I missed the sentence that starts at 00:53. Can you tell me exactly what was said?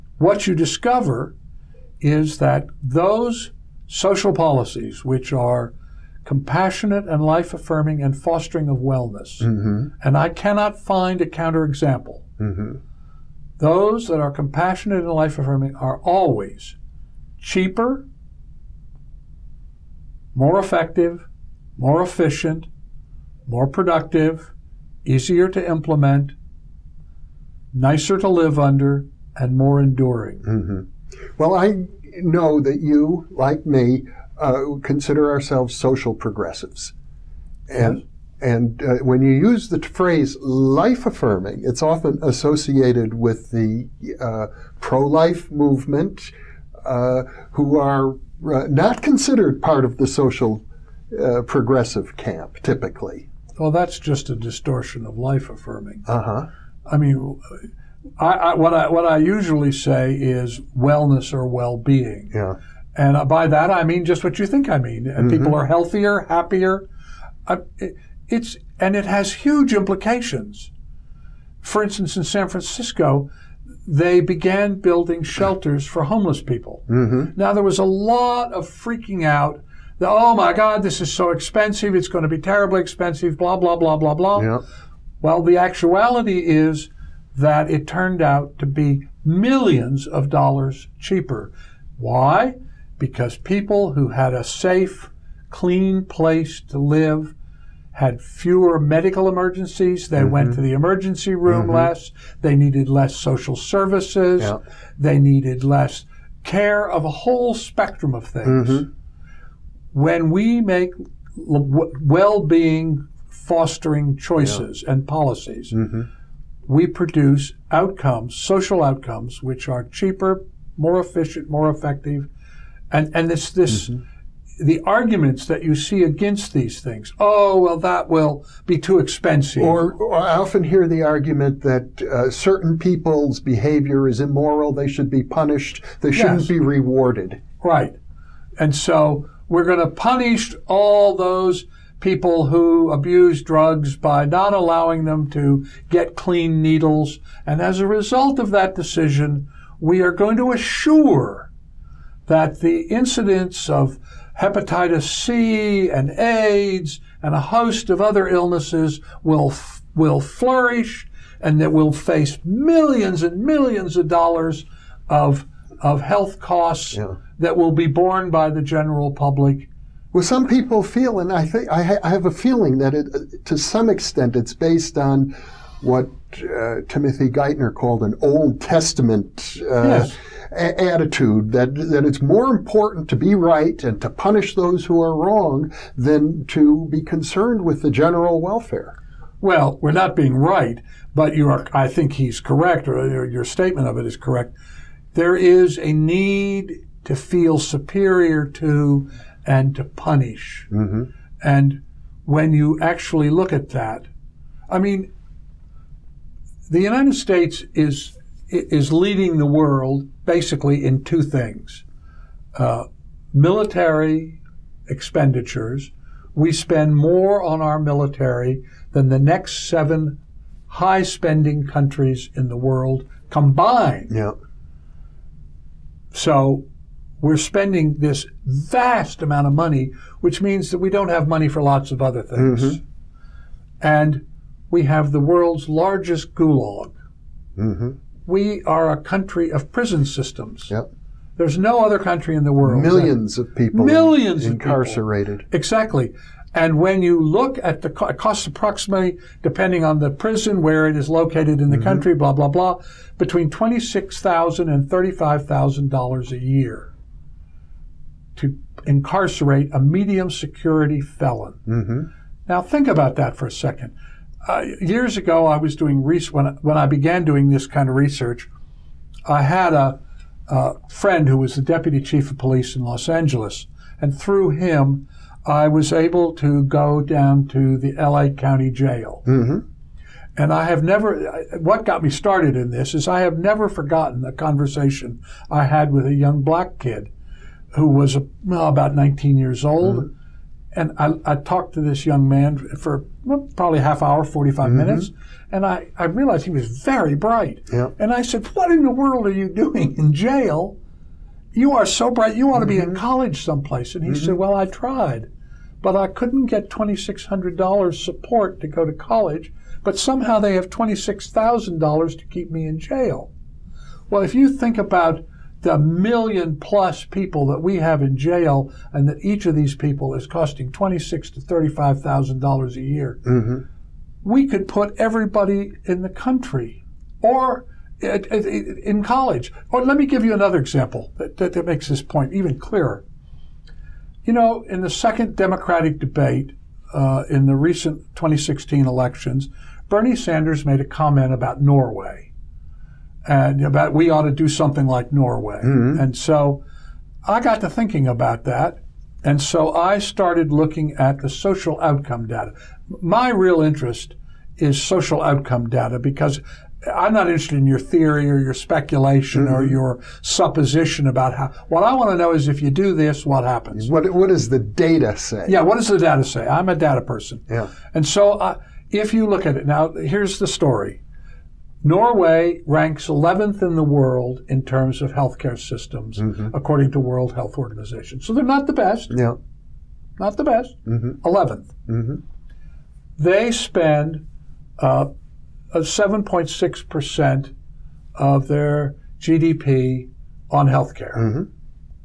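Well, that's just a distortion of life affirming.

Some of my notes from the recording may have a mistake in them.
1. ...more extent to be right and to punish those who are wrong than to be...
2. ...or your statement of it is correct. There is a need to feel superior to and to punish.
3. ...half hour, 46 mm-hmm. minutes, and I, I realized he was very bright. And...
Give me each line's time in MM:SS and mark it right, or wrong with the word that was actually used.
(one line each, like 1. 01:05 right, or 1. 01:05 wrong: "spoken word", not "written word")
1. 03:02 wrong: "important", not "extent"
2. 03:12 right
3. 04:53 wrong: "45", not "46".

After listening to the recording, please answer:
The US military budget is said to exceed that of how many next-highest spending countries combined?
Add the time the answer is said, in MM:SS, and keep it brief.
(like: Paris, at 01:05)
7, at 03:39.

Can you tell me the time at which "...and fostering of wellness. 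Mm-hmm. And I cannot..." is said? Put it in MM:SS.
00:08.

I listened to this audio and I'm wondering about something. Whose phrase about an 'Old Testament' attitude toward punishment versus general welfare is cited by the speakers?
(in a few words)
Timothy Geithner.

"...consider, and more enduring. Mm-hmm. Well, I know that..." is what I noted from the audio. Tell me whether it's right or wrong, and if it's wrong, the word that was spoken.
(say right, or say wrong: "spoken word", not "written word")
wrong: "under", not "consider".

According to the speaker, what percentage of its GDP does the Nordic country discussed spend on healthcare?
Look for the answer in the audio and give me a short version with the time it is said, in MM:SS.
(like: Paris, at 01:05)
7.6%, at 06:25.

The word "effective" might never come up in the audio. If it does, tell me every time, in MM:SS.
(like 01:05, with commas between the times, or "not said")
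00:20, 02:01.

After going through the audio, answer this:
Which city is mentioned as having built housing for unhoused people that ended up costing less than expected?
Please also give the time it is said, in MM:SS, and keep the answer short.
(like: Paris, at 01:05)
San Francisco, at 01:12.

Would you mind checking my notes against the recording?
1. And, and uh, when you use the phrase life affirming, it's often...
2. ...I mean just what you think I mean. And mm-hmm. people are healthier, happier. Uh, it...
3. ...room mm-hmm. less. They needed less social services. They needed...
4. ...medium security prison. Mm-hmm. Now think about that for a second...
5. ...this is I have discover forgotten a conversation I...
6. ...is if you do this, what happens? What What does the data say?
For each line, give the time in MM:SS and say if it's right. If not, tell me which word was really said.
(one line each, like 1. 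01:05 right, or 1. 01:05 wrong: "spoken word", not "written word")
1. 00:37 right
2. 01:03 right
3. 01:41 right
4. 04:19 wrong: "felon", not "prison"
5. 04:42 wrong: "never", not "discover"
6. 06:02 right.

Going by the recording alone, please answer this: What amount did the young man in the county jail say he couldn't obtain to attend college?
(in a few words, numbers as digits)
$2,600.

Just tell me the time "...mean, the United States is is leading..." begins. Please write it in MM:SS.
03:24.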